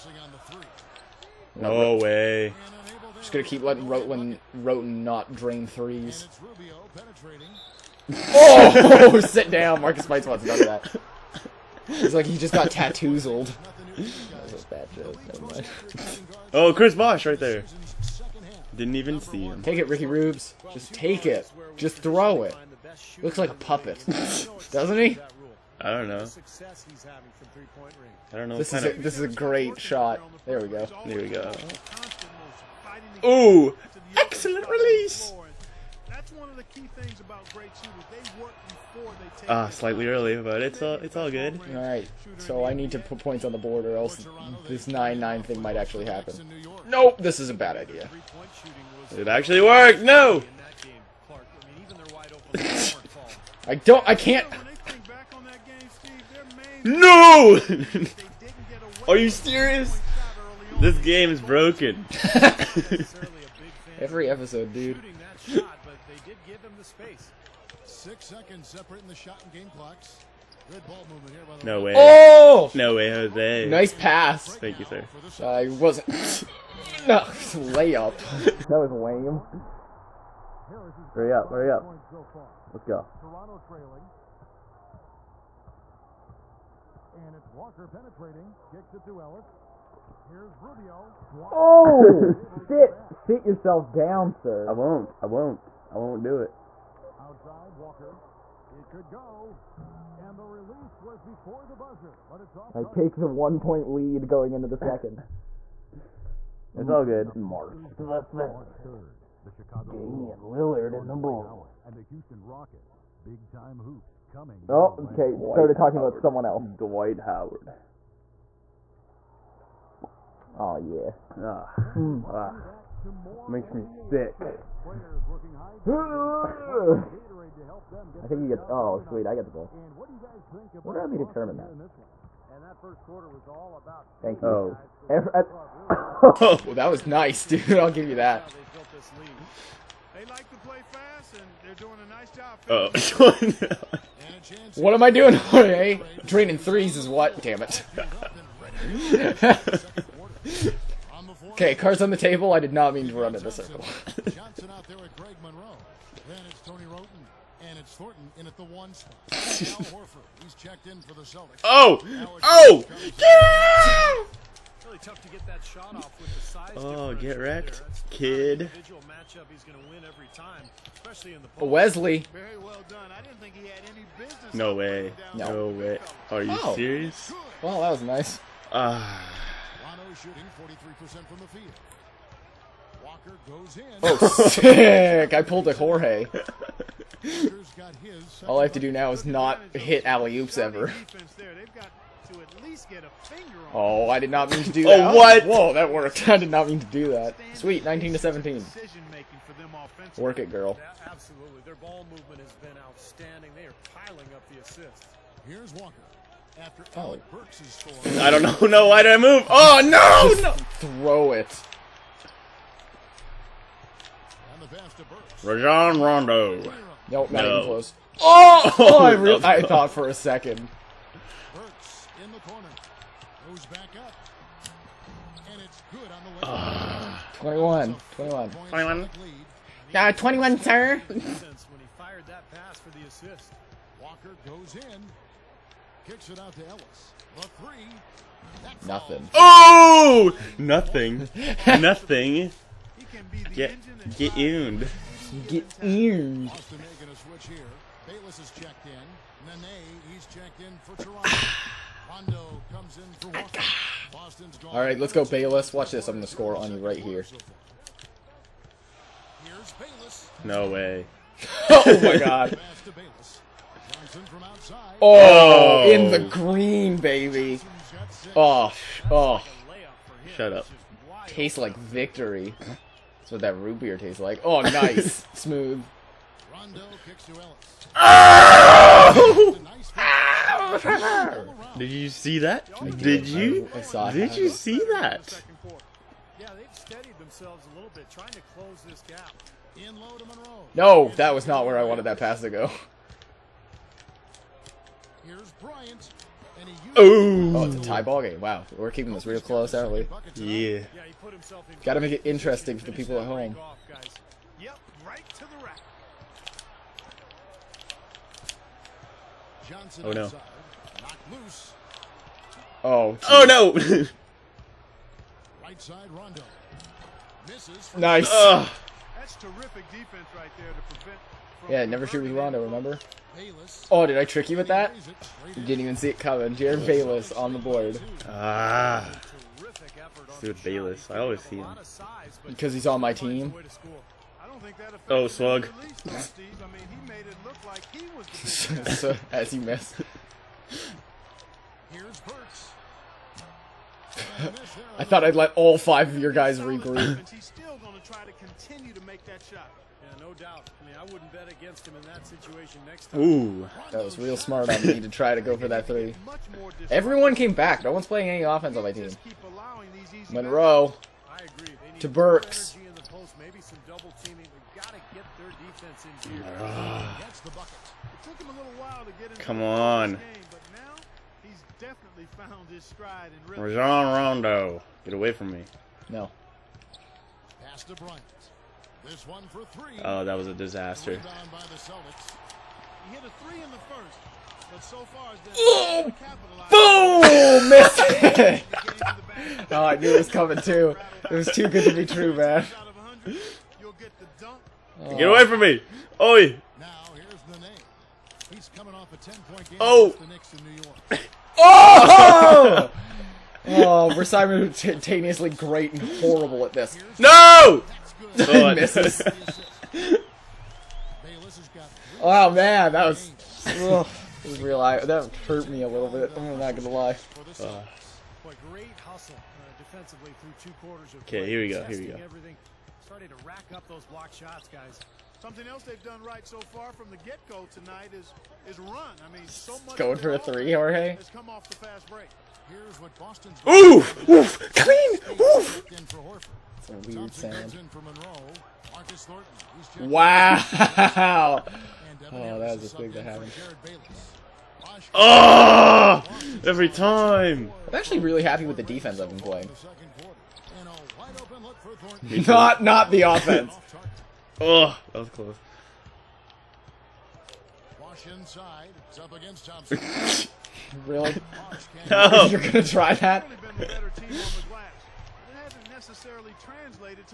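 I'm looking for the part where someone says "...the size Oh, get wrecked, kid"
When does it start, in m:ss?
2:46.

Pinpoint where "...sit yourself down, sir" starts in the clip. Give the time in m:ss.
1:33.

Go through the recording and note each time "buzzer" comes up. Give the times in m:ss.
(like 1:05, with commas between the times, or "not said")
1:41.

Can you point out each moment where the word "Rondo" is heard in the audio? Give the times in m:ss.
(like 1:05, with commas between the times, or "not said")
3:35, 4:12, 5:16, 5:22, 6:14.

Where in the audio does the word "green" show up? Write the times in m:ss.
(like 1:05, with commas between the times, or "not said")
4:26.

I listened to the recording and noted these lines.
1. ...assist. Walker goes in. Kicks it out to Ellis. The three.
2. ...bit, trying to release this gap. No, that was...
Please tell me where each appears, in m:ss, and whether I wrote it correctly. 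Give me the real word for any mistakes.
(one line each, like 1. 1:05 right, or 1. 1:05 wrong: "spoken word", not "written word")
1. 3:53 right
2. 4:47 wrong: "close", not "release".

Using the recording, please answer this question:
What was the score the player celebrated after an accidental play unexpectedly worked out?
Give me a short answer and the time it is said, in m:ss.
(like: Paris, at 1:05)
19 to 17, at 3:17.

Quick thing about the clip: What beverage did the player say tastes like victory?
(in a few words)
Root beer.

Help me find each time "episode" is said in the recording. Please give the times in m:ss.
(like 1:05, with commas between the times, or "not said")
1:04.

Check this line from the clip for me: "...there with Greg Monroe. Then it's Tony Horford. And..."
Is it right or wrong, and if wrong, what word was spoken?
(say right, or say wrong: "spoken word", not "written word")
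wrong: "Roten", not "Horford".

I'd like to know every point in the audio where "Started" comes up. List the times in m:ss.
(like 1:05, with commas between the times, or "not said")
1:55, 7:03.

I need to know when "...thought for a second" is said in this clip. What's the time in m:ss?
3:39.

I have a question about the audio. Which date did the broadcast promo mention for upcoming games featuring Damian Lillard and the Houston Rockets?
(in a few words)
March 3.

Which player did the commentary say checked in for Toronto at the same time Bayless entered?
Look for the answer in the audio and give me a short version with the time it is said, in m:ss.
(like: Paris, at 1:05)
Nene, at 4:09.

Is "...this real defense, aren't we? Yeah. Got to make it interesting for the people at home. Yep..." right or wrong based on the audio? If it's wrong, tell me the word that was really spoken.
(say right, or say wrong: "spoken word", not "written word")
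wrong: "close", not "defense".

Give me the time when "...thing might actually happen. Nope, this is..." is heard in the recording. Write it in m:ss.
0:45.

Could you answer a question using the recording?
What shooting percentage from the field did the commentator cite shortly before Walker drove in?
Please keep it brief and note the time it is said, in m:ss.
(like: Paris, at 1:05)
43%, at 3:00.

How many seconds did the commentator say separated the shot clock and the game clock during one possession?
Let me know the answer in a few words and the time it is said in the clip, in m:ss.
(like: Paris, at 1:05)
6, at 1:07.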